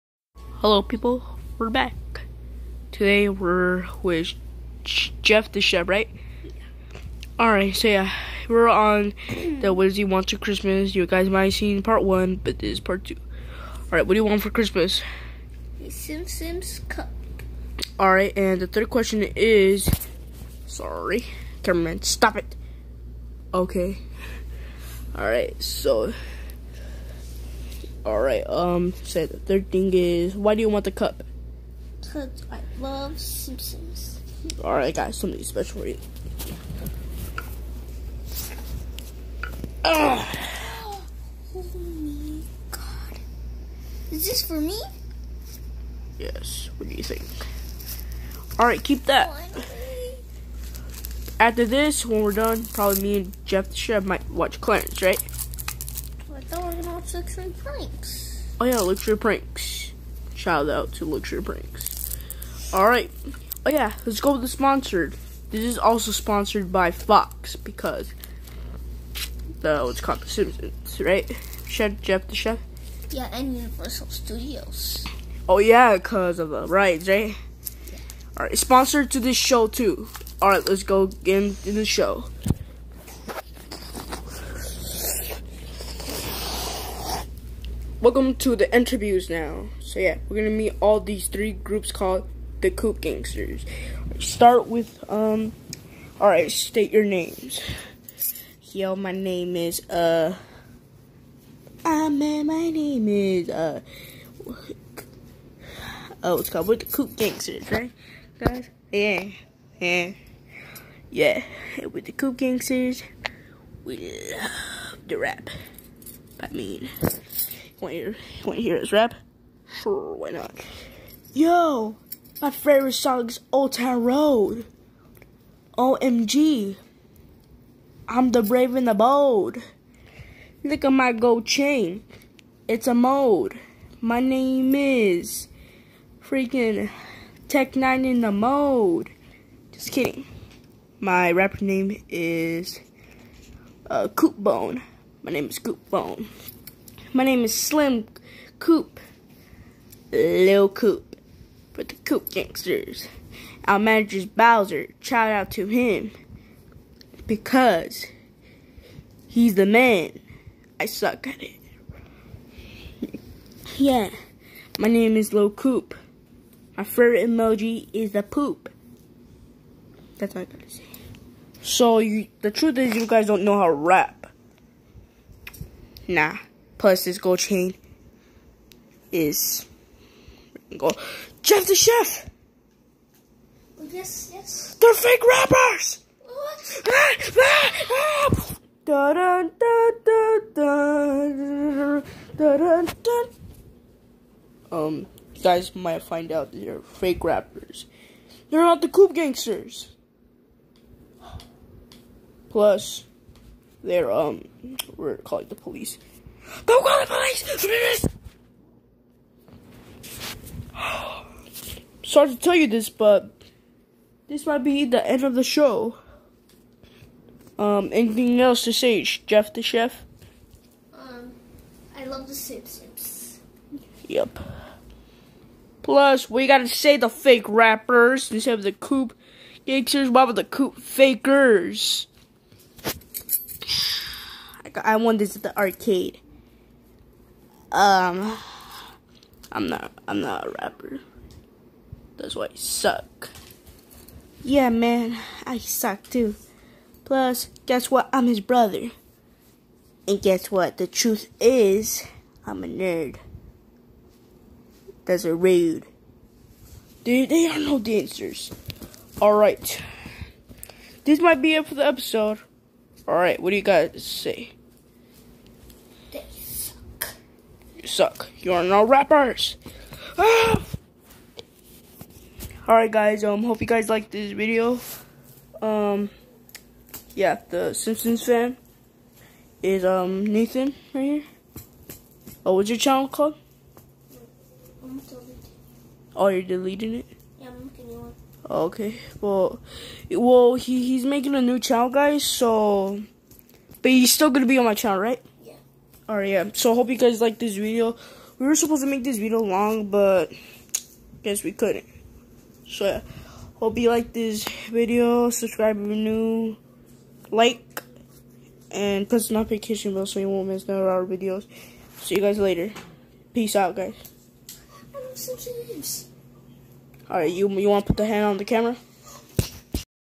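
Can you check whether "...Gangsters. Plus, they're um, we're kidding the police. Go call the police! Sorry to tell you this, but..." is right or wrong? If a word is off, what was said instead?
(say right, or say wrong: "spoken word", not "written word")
wrong: "calling", not "kidding".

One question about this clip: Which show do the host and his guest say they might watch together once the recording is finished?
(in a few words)
Clarence.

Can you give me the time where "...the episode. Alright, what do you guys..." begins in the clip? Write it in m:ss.
4:21.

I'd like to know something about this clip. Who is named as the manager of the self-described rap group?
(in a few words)
Bowser.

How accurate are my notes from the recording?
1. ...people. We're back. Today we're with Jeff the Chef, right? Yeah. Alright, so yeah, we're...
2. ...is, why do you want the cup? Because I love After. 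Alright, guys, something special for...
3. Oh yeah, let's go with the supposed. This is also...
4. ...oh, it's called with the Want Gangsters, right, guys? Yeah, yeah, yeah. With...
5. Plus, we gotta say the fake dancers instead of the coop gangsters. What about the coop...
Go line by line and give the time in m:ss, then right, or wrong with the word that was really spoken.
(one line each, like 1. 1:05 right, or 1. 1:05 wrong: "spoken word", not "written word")
1. 0:00 right
2. 0:29 wrong: "Simpsons", not "After"
3. 1:03 wrong: "sponsored", not "supposed"
4. 1:46 wrong: "Coop", not "Want"
5. 3:45 wrong: "rappers", not "dancers".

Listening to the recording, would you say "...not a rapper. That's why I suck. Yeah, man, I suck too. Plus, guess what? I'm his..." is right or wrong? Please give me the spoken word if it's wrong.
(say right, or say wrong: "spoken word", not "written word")
right.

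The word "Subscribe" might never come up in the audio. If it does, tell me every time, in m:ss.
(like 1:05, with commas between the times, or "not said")
5:05.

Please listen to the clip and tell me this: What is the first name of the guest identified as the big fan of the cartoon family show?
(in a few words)
Nathan.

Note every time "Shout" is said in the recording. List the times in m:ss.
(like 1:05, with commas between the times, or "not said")
1:00, 2:35.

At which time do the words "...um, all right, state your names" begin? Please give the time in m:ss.
1:35.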